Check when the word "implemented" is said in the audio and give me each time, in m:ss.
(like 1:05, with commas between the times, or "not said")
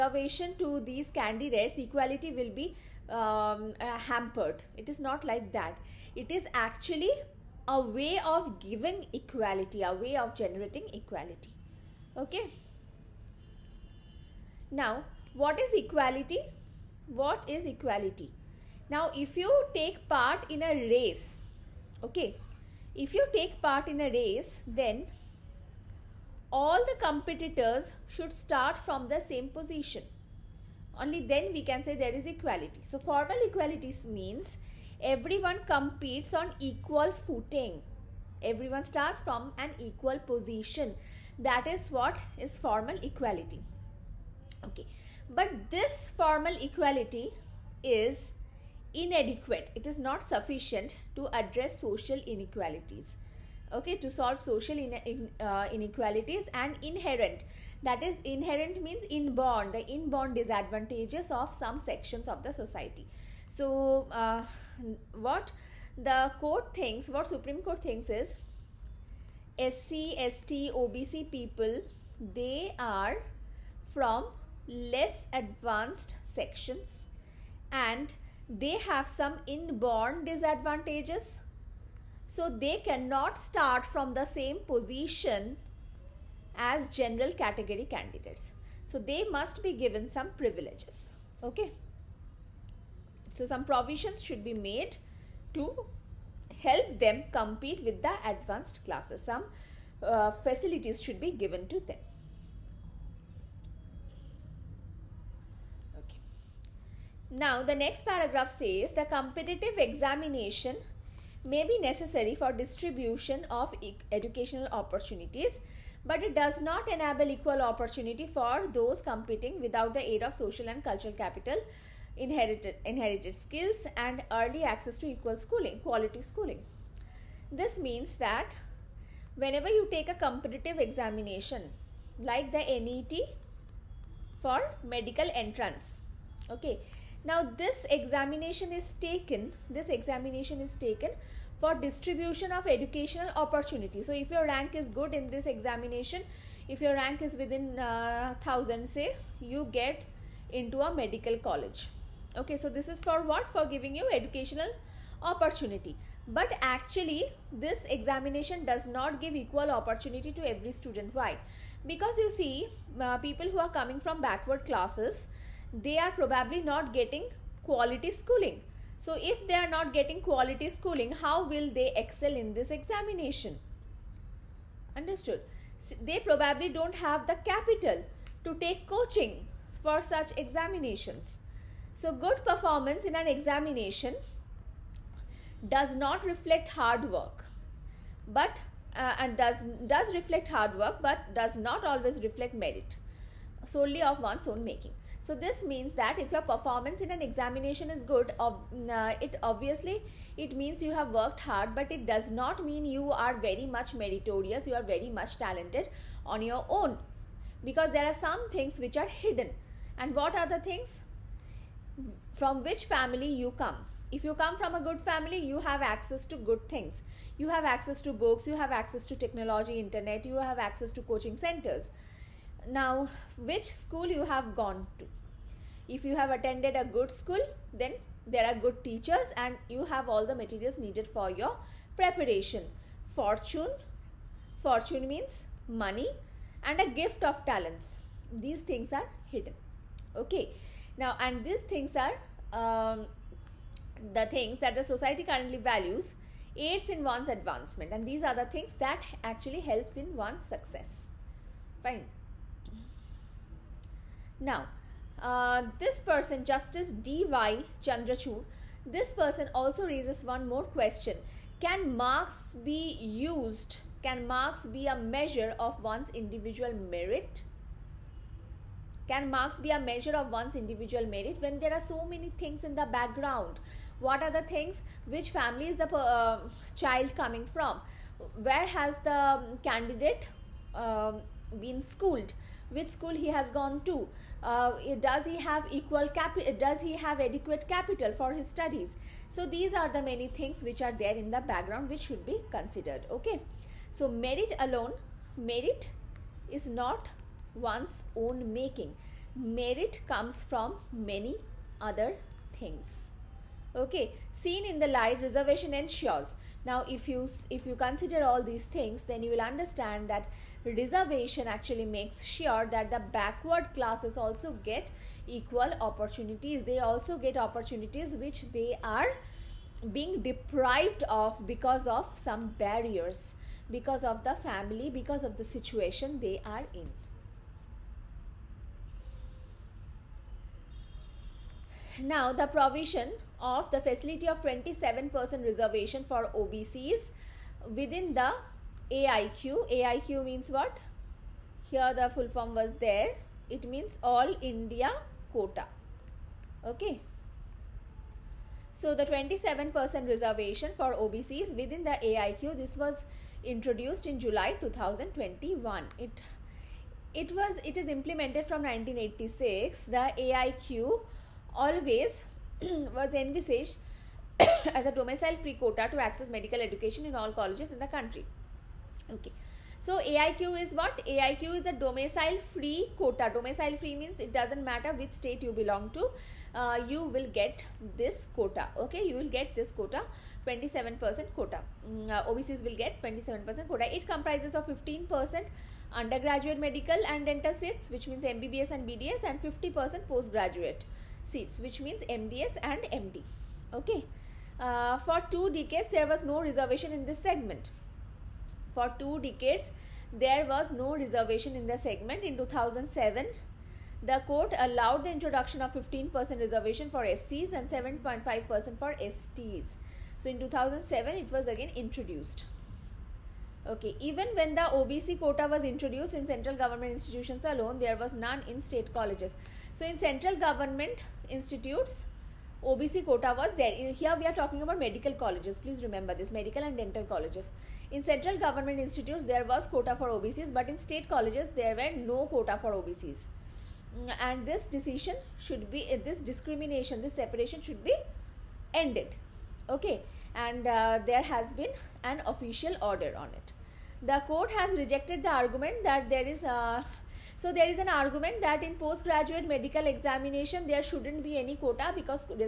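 5:57.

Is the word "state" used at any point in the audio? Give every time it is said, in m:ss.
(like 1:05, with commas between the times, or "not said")
6:15, 6:58, 7:10.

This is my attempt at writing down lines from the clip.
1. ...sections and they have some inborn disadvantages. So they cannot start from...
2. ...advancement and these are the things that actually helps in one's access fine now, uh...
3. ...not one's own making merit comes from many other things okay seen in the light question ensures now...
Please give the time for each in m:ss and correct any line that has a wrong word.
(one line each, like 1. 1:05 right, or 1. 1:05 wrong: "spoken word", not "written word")
1. 1:16 right
2. 4:07 wrong: "success", not "access"
3. 4:56 wrong: "reservation", not "question".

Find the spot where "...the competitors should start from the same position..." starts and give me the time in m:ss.
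0:26.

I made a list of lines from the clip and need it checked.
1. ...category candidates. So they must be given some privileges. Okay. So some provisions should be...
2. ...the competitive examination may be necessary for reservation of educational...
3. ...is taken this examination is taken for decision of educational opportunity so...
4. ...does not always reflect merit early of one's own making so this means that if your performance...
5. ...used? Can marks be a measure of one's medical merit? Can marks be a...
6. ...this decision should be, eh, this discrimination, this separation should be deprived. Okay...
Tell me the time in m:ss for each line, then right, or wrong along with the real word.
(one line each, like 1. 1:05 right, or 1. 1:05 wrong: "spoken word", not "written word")
1. 1:27 right
2. 1:48 wrong: "distribution", not "reservation"
3. 2:18 wrong: "distribution", not "decision"
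4. 3:11 wrong: "solely", not "early"
5. 4:22 wrong: "individual", not "medical"
6. 7:14 wrong: "ended", not "deprived".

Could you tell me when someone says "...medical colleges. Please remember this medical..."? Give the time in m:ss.
7:04.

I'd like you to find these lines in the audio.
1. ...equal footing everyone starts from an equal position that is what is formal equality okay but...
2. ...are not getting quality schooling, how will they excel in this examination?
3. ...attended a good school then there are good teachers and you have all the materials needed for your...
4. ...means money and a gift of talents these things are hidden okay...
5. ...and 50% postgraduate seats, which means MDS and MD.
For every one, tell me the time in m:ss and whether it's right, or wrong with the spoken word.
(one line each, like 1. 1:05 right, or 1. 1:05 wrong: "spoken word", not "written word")
1. 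0:36 right
2. 2:49 right
3. 3:46 right
4. 3:55 right
5. 6:29 right.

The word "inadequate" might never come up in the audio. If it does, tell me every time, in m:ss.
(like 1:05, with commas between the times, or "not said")
0:48.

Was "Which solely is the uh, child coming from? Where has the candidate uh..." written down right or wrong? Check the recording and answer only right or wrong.
wrong.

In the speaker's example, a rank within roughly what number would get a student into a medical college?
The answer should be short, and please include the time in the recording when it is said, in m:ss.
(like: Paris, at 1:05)
1000, at 2:28.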